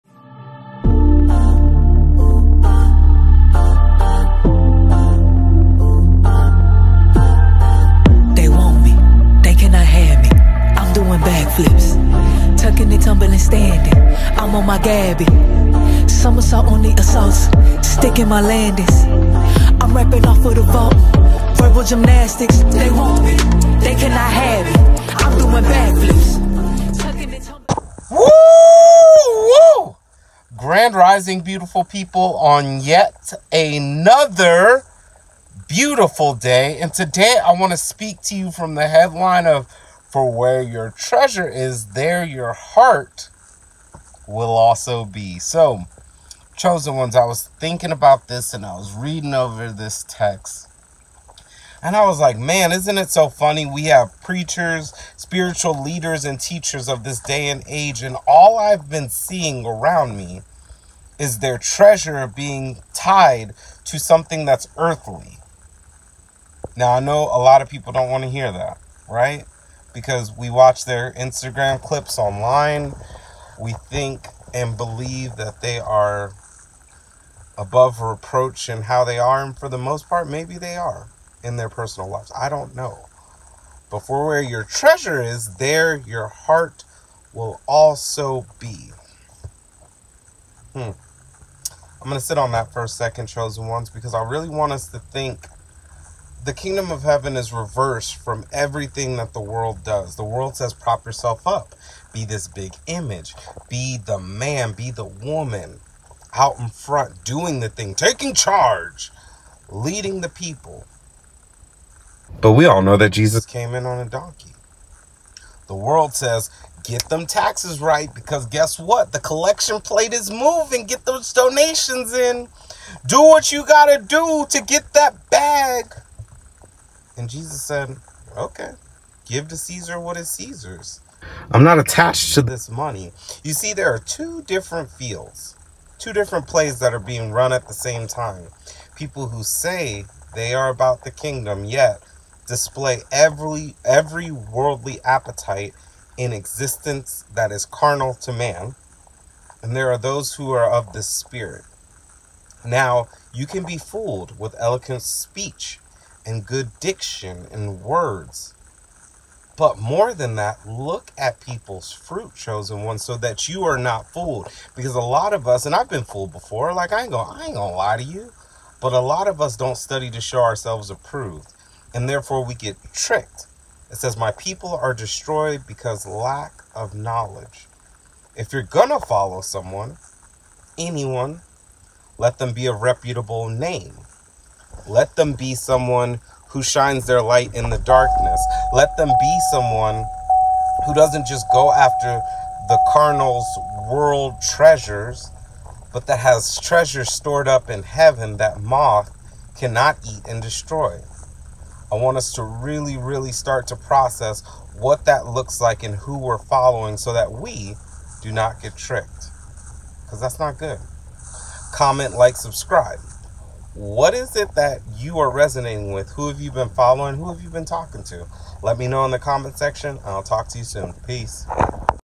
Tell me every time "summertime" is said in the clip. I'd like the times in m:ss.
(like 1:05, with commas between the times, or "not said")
not said.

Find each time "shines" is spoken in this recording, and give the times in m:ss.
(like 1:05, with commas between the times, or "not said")
3:06.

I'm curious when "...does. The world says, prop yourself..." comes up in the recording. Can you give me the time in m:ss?
1:39.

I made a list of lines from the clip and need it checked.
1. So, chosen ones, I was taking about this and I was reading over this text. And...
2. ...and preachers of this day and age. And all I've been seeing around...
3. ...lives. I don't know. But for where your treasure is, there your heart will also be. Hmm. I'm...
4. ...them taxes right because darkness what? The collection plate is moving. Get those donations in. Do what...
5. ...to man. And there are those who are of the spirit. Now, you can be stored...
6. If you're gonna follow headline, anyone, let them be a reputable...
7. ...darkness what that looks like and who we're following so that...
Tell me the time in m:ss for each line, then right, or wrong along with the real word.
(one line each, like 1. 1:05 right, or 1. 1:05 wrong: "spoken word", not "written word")
1. 0:45 wrong: "thinking", not "taking"
2. 0:56 wrong: "teachers", not "preachers"
3. 1:22 right
4. 1:57 wrong: "guess", not "darkness"
5. 2:28 wrong: "fooled", not "stored"
6. 2:58 wrong: "someone", not "headline"
7. 3:23 wrong: "process", not "darkness".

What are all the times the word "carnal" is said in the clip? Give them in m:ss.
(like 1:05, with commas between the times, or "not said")
2:27, 3:12.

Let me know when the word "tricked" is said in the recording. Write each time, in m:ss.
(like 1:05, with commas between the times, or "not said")
2:52, 3:28.